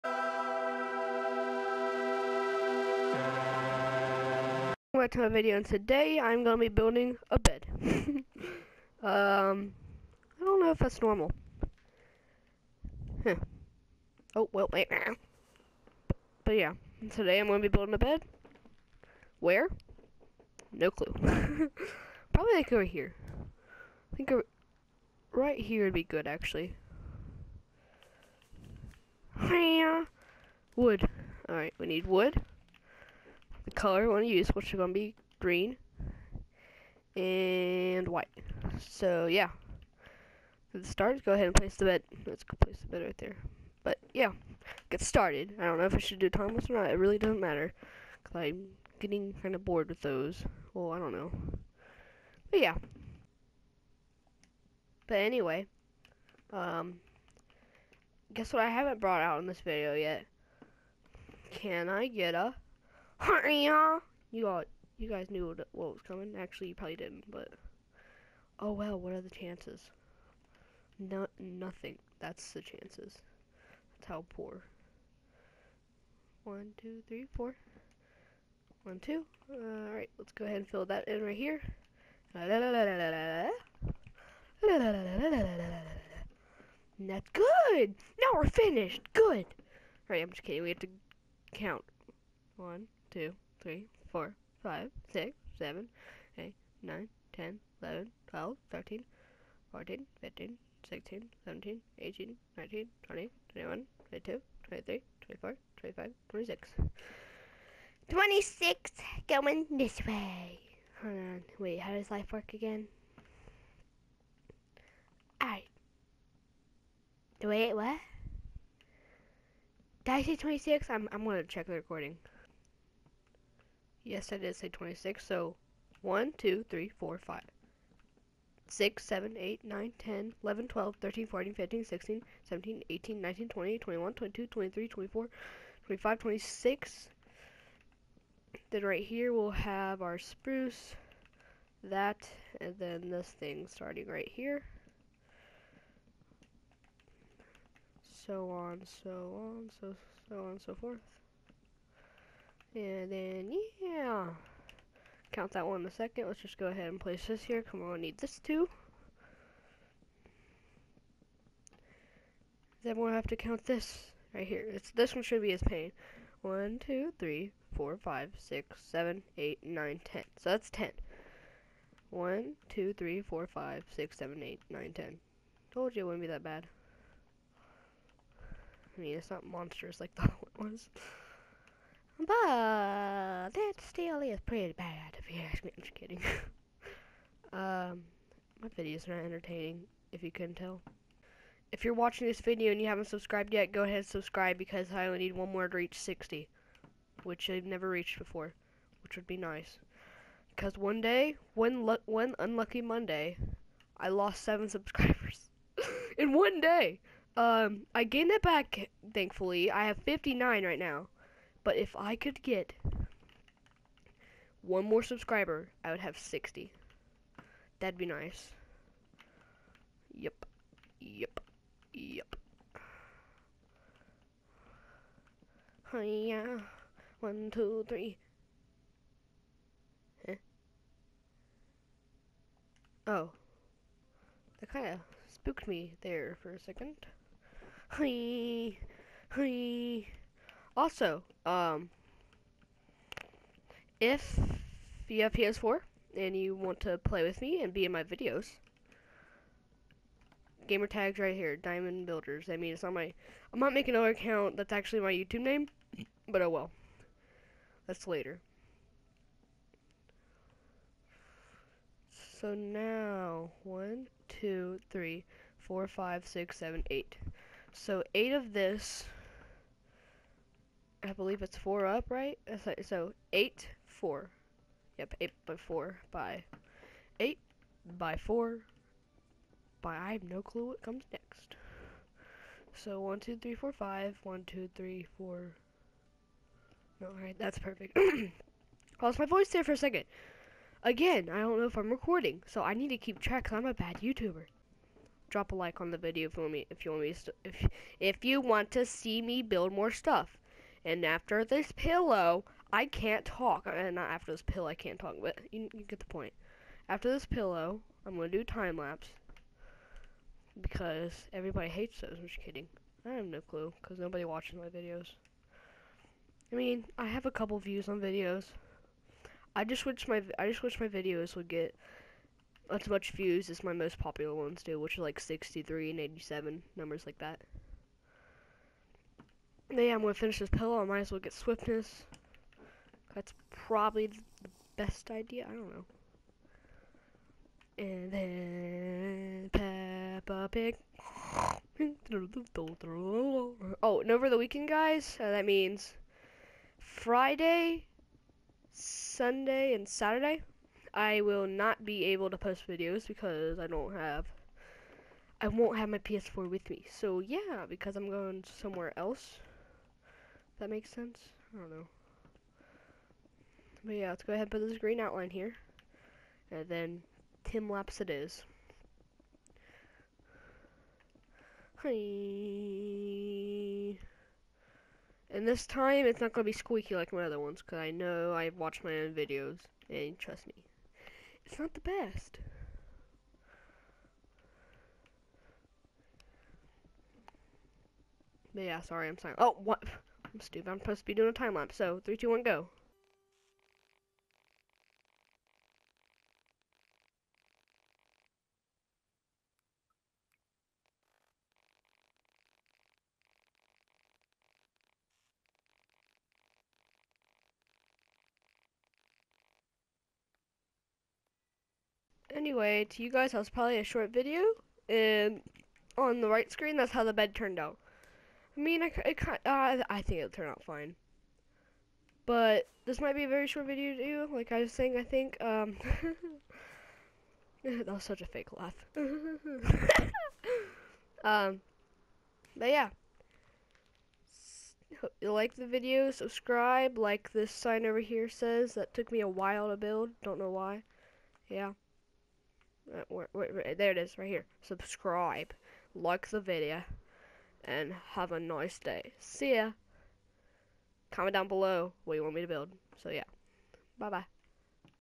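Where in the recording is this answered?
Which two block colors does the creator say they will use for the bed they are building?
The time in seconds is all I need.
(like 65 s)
35 s.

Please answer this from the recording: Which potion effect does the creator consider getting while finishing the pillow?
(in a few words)
swiftness.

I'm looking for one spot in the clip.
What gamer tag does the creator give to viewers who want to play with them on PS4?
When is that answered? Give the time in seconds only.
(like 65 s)
251 s.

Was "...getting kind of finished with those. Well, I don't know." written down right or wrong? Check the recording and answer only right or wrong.
wrong.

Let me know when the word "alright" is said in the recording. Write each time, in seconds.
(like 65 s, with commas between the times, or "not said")
31 s, 115 s, 287 s.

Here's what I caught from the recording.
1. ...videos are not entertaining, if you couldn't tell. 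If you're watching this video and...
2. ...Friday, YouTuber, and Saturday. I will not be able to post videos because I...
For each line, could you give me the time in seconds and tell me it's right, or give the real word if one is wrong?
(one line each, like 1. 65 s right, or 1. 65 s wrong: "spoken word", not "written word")
1. 188 s right
2. 346 s wrong: "Sunday", not "YouTuber".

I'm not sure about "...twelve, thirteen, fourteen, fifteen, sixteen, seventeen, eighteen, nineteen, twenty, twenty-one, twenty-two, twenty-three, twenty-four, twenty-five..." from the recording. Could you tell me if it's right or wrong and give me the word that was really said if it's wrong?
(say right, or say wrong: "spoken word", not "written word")
right.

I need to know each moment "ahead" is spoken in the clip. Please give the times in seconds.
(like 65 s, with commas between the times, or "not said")
41 s, 80 s, 156 s, 193 s, 364 s.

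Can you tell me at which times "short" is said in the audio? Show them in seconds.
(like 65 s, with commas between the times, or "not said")
413 s, 423 s.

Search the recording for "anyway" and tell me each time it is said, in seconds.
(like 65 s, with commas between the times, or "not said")
55 s, 412 s.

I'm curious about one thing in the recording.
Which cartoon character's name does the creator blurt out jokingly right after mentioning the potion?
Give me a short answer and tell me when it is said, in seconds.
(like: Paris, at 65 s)
Peppa Pig, at 340 s.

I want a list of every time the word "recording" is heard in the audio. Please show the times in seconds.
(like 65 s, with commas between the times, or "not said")
121 s, 291 s.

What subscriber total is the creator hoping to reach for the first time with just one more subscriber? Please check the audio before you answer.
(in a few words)
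60.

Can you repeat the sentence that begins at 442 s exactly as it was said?
Uh, where, where, there it is, right here.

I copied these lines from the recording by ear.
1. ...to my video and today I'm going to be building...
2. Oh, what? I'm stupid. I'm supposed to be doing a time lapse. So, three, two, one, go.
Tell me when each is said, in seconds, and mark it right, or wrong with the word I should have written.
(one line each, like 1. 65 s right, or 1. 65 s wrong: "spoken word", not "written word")
1. 5 s right
2. 389 s right.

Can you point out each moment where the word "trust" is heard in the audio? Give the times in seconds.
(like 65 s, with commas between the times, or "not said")
380 s.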